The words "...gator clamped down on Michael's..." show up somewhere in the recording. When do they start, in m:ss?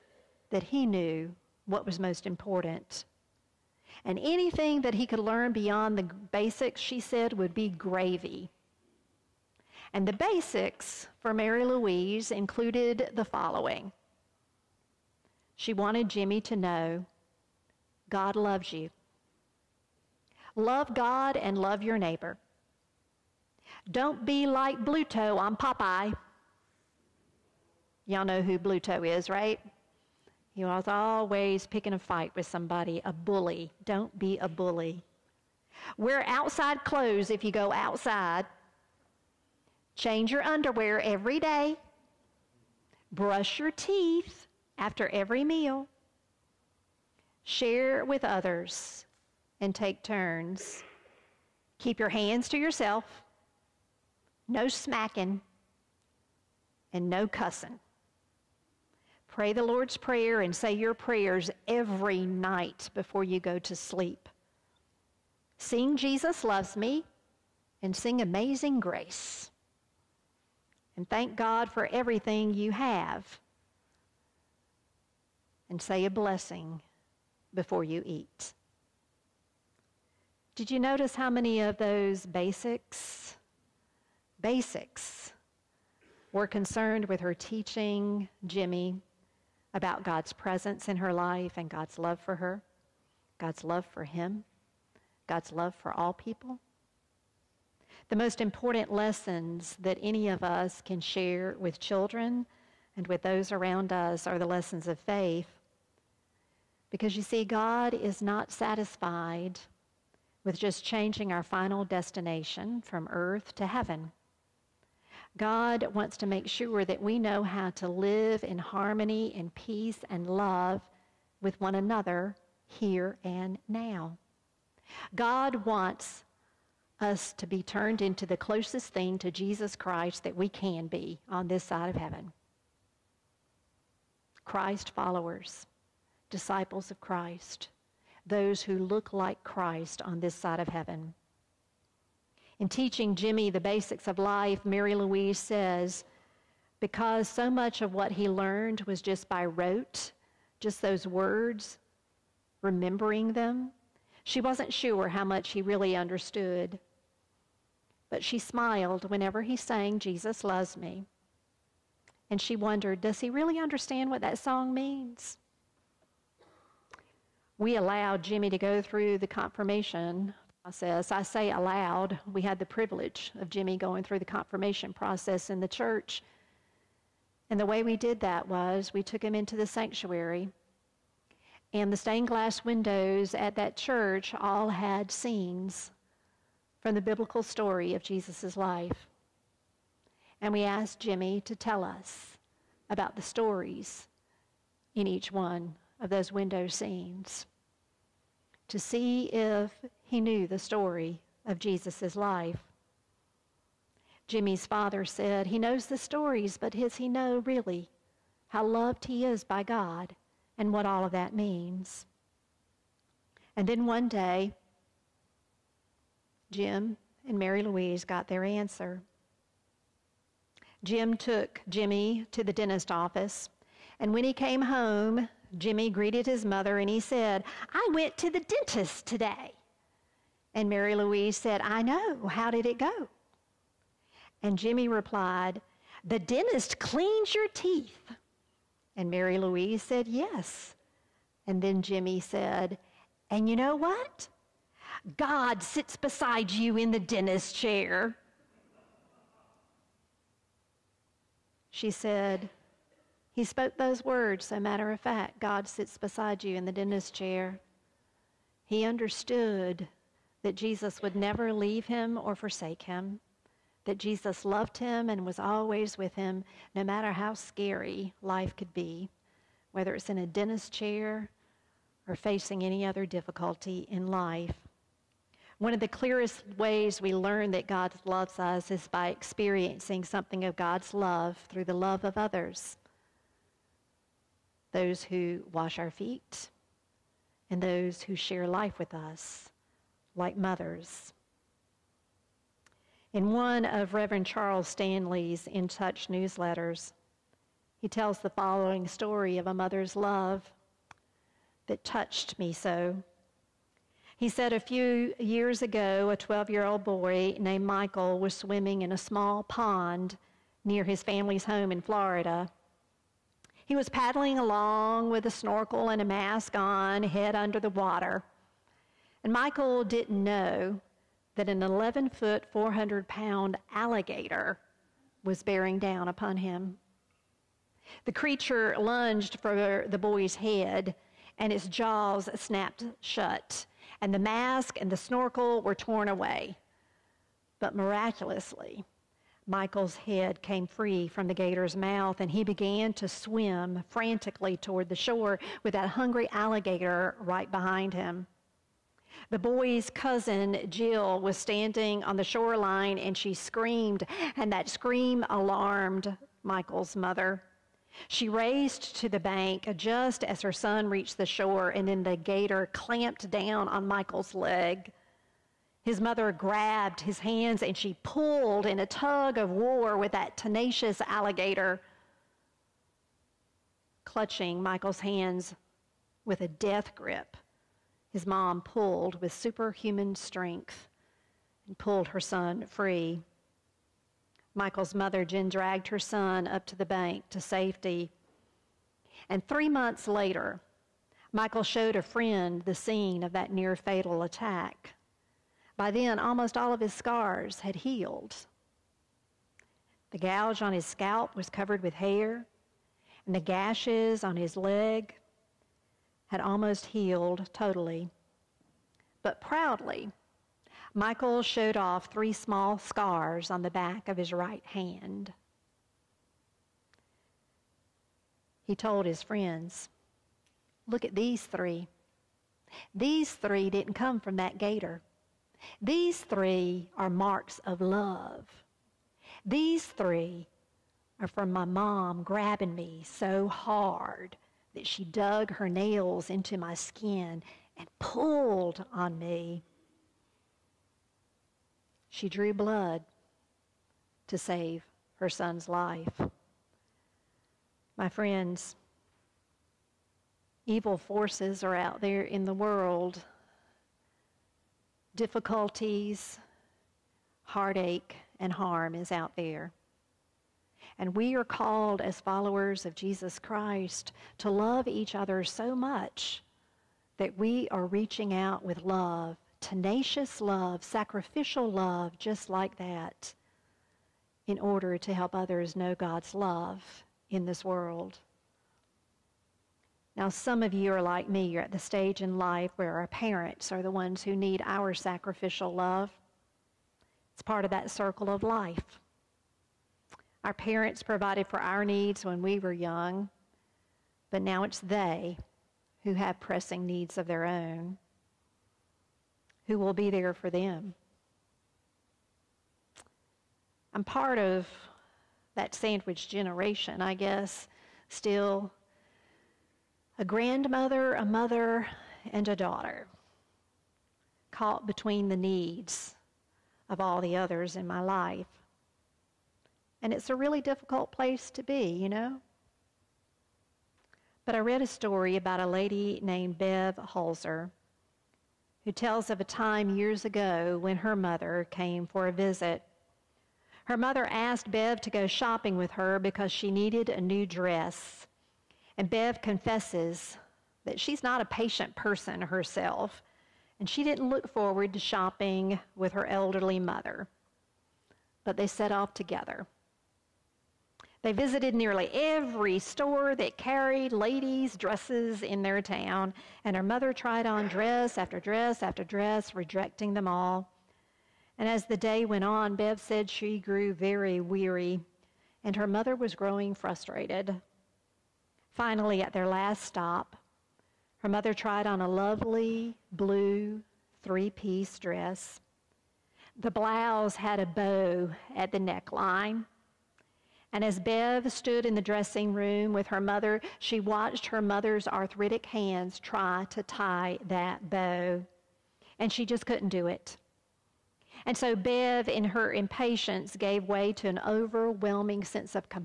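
6:02.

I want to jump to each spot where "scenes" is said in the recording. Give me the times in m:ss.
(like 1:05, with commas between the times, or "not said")
3:05, 3:16, 6:32.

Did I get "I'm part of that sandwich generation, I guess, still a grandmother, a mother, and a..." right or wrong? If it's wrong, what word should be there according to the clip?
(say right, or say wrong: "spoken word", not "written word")
right.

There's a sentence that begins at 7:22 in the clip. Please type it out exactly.
She drew blood to save her son's life.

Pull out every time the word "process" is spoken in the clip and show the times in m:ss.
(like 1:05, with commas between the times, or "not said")
2:50, 2:54.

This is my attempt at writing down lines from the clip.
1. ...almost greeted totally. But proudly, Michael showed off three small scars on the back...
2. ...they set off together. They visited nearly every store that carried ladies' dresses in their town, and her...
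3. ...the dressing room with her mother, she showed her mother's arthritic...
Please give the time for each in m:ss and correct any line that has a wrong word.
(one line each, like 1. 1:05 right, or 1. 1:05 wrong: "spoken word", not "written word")
1. 6:46 wrong: "healed", not "greeted"
2. 9:08 right
3. 9:41 wrong: "watched", not "showed".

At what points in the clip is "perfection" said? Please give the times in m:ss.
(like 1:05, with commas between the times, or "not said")
not said.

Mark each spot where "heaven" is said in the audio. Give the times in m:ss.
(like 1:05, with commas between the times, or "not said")
1:53, 2:11, 2:20.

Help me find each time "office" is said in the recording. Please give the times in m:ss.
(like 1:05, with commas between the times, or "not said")
3:42.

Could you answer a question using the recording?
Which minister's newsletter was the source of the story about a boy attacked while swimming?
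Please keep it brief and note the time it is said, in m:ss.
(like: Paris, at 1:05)
Charles Stanley, at 4:54.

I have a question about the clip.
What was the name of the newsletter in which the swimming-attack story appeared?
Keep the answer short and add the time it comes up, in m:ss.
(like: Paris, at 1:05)
In Touch, at 4:55.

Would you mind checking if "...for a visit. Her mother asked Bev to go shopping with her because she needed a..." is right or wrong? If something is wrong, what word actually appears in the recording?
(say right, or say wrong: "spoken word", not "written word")
right.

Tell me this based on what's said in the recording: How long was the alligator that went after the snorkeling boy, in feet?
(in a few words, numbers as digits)
11 feet.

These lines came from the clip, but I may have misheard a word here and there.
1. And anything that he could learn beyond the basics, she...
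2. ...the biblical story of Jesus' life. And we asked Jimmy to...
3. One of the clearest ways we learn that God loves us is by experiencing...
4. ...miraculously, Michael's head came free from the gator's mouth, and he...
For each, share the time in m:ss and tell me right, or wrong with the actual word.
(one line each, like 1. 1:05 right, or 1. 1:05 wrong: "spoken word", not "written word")
1. 0:04 right
2. 3:06 right
3. 4:35 right
4. 5:37 right.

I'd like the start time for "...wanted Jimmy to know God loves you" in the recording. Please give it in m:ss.
0:15.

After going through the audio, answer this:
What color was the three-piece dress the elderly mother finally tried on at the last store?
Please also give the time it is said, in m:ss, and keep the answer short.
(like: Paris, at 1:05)
Blue, at 9:33.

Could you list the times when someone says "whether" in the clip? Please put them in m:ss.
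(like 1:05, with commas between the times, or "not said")
4:29.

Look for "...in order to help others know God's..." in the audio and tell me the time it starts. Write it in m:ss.
7:54.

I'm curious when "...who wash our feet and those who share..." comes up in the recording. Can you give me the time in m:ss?
4:45.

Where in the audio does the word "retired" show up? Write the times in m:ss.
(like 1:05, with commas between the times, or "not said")
not said.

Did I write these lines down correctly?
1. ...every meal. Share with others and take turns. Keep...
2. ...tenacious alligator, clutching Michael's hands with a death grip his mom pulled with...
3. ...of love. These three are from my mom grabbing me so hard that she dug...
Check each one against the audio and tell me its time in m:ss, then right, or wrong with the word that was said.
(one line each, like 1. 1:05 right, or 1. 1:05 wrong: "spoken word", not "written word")
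1. 0:45 right
2. 6:10 right
3. 7:07 right.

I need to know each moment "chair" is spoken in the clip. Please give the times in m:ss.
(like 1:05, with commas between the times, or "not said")
4:07, 4:17, 4:30.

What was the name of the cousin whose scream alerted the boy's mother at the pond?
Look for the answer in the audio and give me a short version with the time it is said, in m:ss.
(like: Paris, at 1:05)
Jill, at 5:50.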